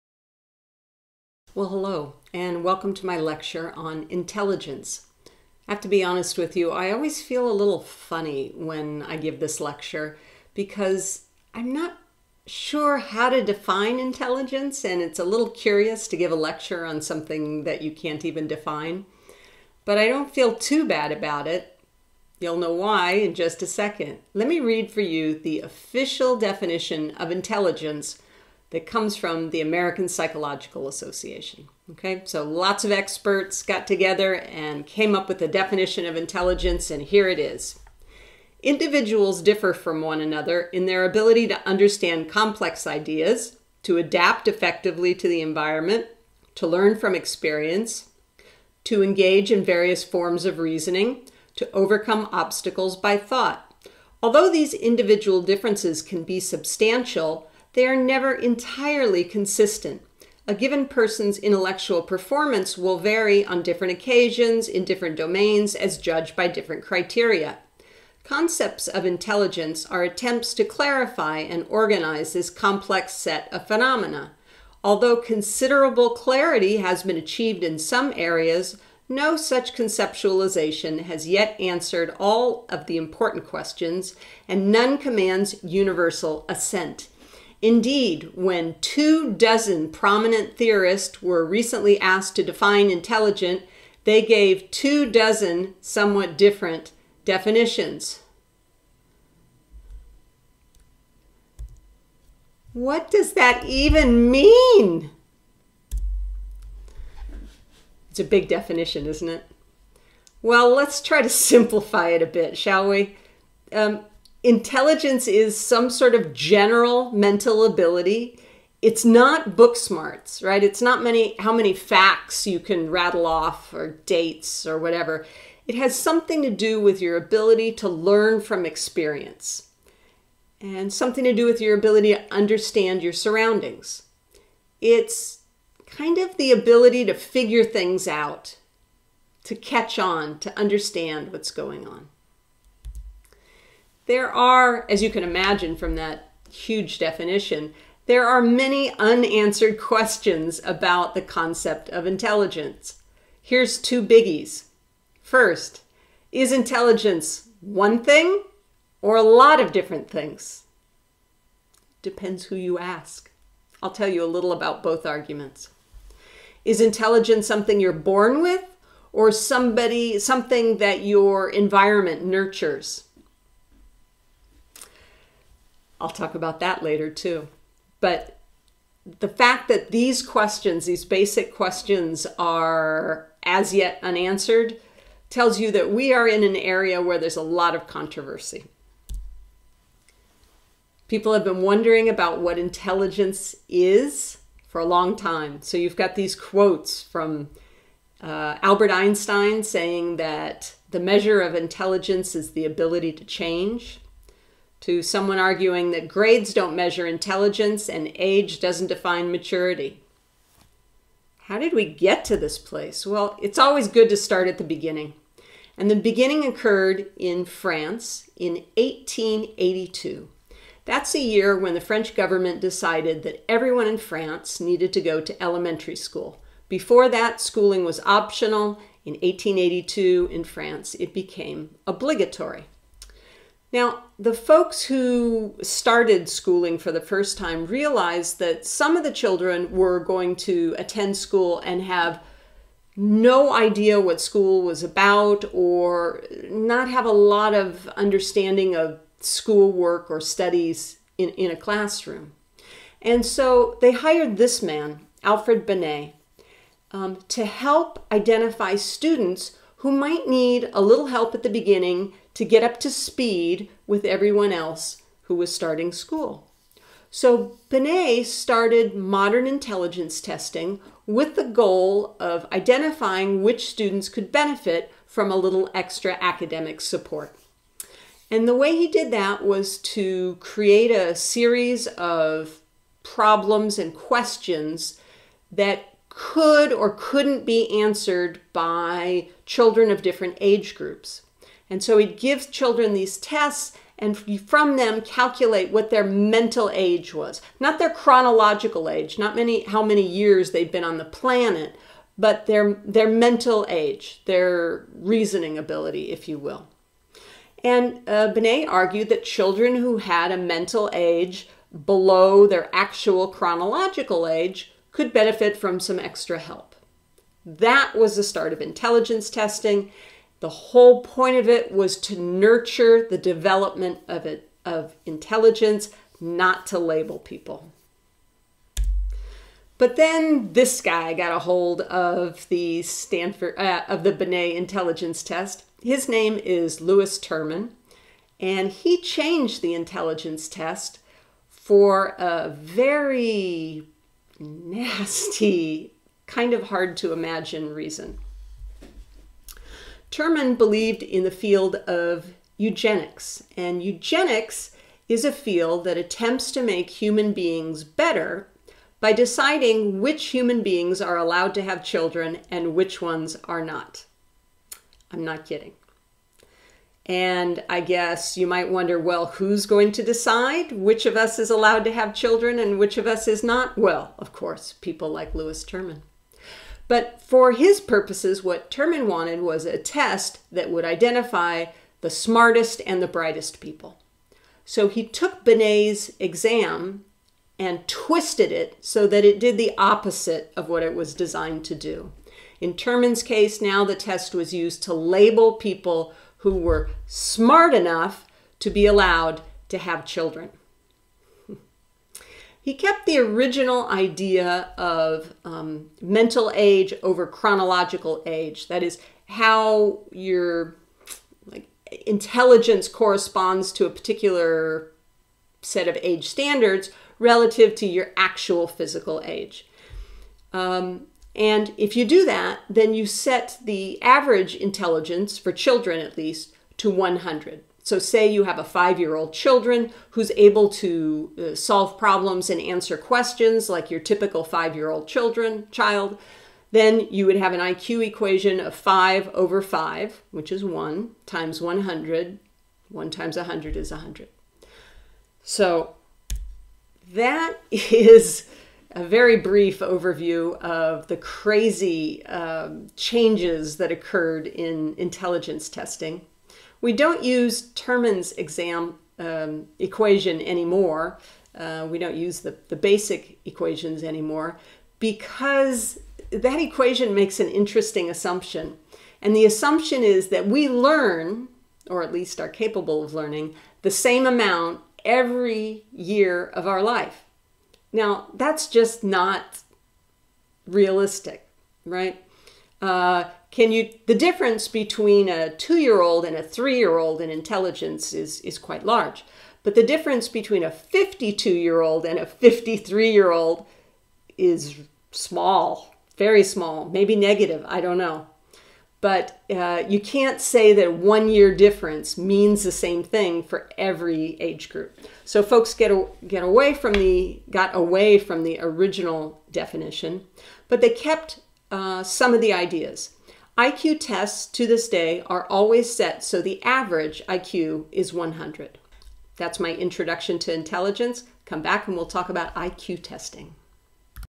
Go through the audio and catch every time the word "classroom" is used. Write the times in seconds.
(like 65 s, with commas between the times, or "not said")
251 s.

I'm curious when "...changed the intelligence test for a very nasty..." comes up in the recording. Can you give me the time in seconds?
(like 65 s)
338 s.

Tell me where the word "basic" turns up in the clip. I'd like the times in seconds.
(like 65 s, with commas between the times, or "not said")
181 s, 462 s.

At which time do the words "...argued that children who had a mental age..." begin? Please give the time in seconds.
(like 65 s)
308 s.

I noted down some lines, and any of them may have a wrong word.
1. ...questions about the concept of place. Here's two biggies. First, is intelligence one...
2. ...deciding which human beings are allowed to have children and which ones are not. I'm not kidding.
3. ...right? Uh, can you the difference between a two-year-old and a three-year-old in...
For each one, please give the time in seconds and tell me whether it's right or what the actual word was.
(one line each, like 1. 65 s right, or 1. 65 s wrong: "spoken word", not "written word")
1. 149 s wrong: "intelligence", not "place"
2. 359 s right
3. 481 s right.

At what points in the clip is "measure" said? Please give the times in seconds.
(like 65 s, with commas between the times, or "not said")
200 s, 206 s.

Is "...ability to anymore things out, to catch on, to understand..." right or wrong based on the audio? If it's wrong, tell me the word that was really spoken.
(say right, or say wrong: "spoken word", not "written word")
wrong: "figure", not "anymore".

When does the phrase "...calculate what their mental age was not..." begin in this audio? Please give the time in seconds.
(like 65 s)
295 s.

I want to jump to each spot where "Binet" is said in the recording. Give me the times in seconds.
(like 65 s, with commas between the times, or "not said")
255 s, 267 s, 308 s, 334 s, 385 s.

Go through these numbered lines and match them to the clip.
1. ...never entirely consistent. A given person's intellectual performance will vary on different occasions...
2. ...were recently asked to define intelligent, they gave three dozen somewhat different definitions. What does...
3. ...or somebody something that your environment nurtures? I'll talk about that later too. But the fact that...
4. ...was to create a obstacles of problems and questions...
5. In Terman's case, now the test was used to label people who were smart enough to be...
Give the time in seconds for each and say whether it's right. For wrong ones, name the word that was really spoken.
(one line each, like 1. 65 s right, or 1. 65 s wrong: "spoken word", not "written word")
1. 57 s right
2. 91 s wrong: "two", not "three"
3. 169 s right
4. 279 s wrong: "series", not "obstacles"
5. 392 s right.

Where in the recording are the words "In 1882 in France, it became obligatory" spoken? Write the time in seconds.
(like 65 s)
229 s.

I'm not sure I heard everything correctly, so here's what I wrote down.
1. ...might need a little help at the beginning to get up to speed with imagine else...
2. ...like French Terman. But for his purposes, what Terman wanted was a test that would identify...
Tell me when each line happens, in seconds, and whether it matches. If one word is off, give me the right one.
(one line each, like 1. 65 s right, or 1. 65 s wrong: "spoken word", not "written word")
1. 259 s wrong: "everyone", not "imagine"
2. 375 s wrong: "Lewis", not "French".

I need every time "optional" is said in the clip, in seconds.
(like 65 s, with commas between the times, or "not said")
228 s.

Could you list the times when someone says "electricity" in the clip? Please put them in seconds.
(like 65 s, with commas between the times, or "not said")
not said.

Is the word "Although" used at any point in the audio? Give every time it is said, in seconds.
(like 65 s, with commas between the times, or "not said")
54 s, 74 s.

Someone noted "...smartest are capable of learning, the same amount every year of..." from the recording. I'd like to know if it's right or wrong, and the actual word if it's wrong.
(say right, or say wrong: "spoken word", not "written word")
wrong: "least", not "smartest".